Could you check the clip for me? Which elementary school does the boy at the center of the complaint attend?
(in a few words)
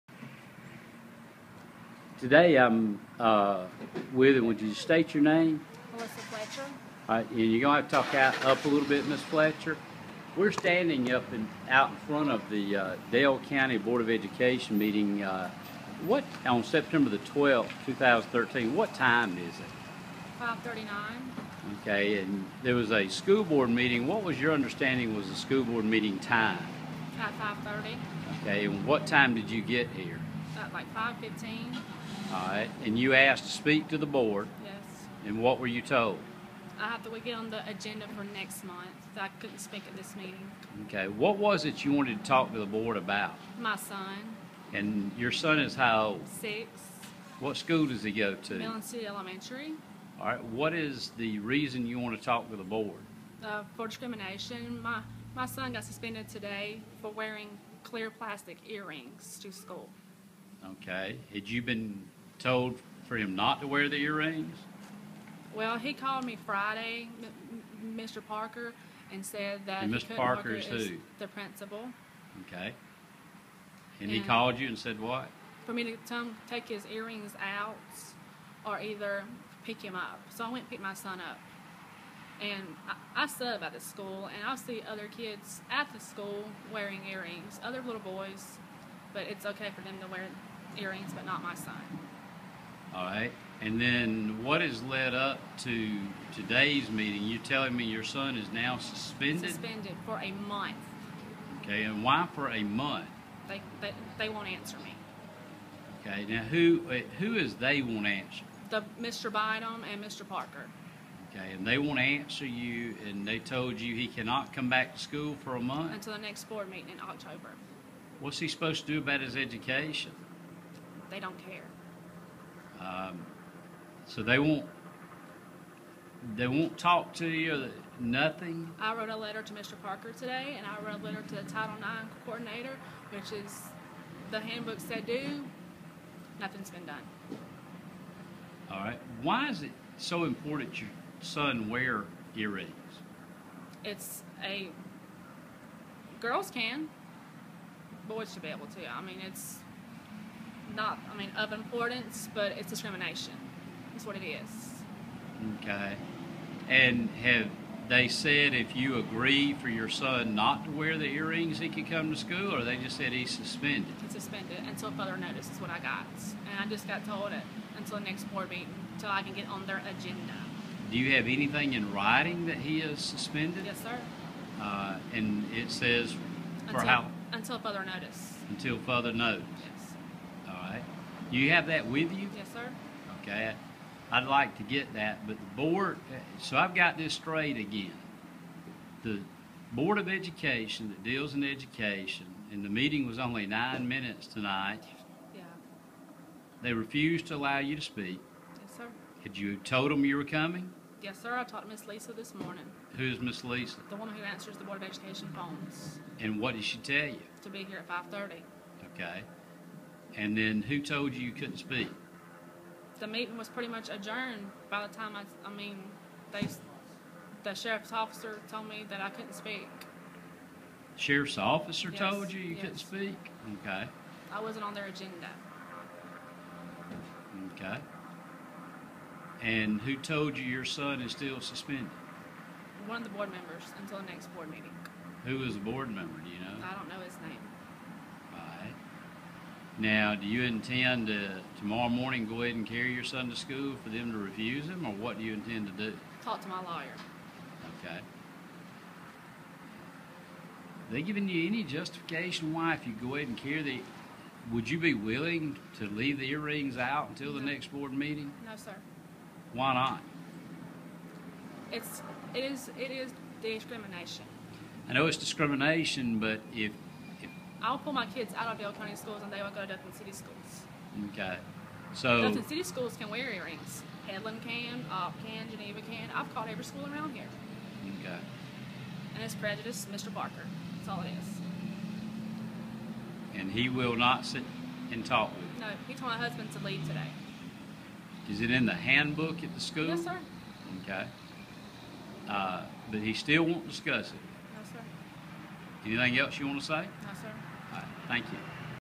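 Midland City Elementary.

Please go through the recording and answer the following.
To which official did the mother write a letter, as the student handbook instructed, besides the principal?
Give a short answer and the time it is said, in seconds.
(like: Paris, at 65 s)
Title IX coordinator, at 131 s.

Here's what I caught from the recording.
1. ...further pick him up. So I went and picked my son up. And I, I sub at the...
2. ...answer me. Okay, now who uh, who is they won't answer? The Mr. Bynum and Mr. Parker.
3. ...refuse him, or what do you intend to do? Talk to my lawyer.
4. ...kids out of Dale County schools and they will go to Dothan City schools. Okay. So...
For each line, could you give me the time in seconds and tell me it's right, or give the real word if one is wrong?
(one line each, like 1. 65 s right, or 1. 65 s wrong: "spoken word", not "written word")
1. 78 s wrong: "either", not "further"
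2. 104 s right
3. 244 s right
4. 268 s right.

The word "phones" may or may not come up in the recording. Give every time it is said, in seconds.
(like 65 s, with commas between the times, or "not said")
205 s.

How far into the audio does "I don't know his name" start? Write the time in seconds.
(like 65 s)
236 s.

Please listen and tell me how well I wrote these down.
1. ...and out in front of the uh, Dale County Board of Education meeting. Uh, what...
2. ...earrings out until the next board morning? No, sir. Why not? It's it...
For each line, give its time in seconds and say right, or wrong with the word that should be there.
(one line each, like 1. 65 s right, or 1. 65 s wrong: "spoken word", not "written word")
1. 11 s right
2. 256 s wrong: "meeting", not "morning".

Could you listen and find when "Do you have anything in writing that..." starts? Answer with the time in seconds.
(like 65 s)
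170 s.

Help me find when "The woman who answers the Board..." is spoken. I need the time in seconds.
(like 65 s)
203 s.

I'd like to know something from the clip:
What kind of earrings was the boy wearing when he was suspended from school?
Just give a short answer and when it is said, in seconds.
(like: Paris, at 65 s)
clear plastic earrings, at 57 s.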